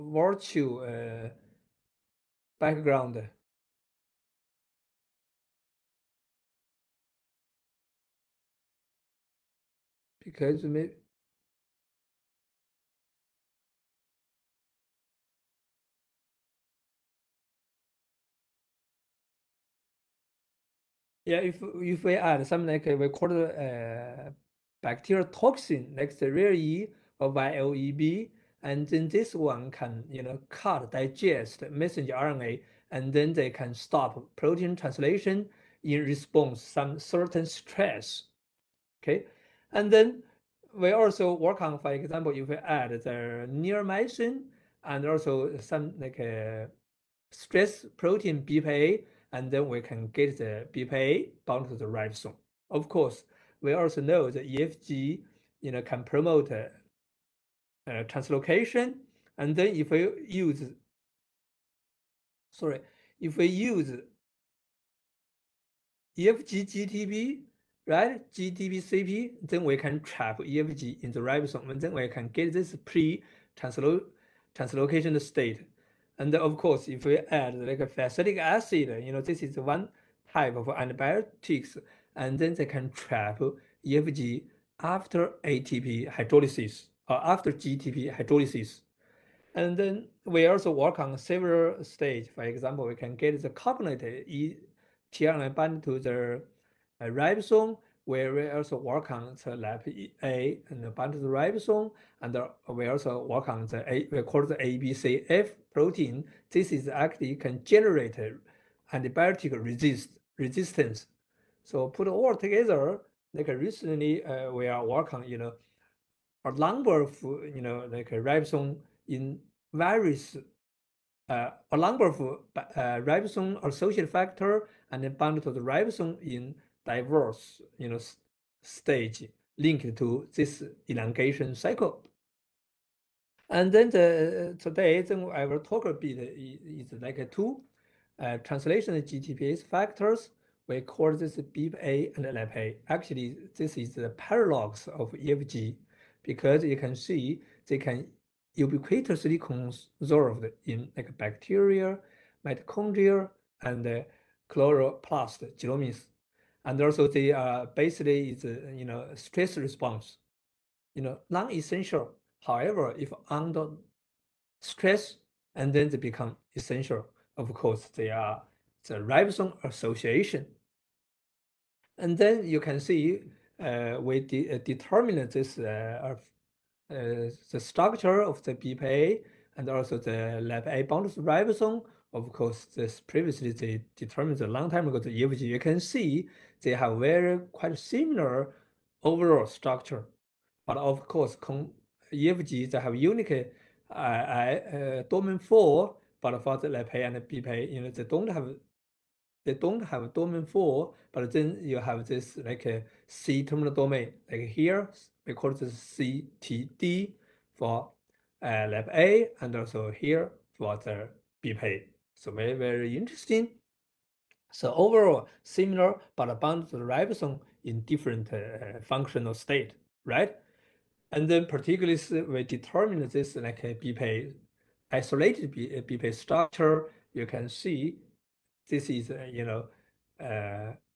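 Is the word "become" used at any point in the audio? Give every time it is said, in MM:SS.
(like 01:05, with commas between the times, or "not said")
02:45.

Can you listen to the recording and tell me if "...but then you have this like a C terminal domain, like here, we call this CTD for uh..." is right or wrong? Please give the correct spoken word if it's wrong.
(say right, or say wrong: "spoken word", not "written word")
right.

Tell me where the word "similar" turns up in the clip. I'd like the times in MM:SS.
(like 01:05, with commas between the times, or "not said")
03:07, 03:35.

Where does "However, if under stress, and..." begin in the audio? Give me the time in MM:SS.
02:42.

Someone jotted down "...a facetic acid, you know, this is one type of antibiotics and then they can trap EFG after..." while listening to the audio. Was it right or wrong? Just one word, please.
right.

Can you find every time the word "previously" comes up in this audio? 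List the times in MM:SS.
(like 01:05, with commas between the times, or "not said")
03:02.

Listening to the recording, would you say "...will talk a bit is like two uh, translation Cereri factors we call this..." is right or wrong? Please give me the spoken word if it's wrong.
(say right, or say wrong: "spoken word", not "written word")
wrong: "GTPase", not "Cereri".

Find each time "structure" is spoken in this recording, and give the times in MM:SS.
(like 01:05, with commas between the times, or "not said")
02:57, 03:09, 03:46.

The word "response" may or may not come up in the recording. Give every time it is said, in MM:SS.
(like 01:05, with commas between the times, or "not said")
00:36, 02:39.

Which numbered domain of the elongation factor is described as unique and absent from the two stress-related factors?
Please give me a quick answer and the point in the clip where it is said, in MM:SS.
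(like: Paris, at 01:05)
Domain four, at 03:15.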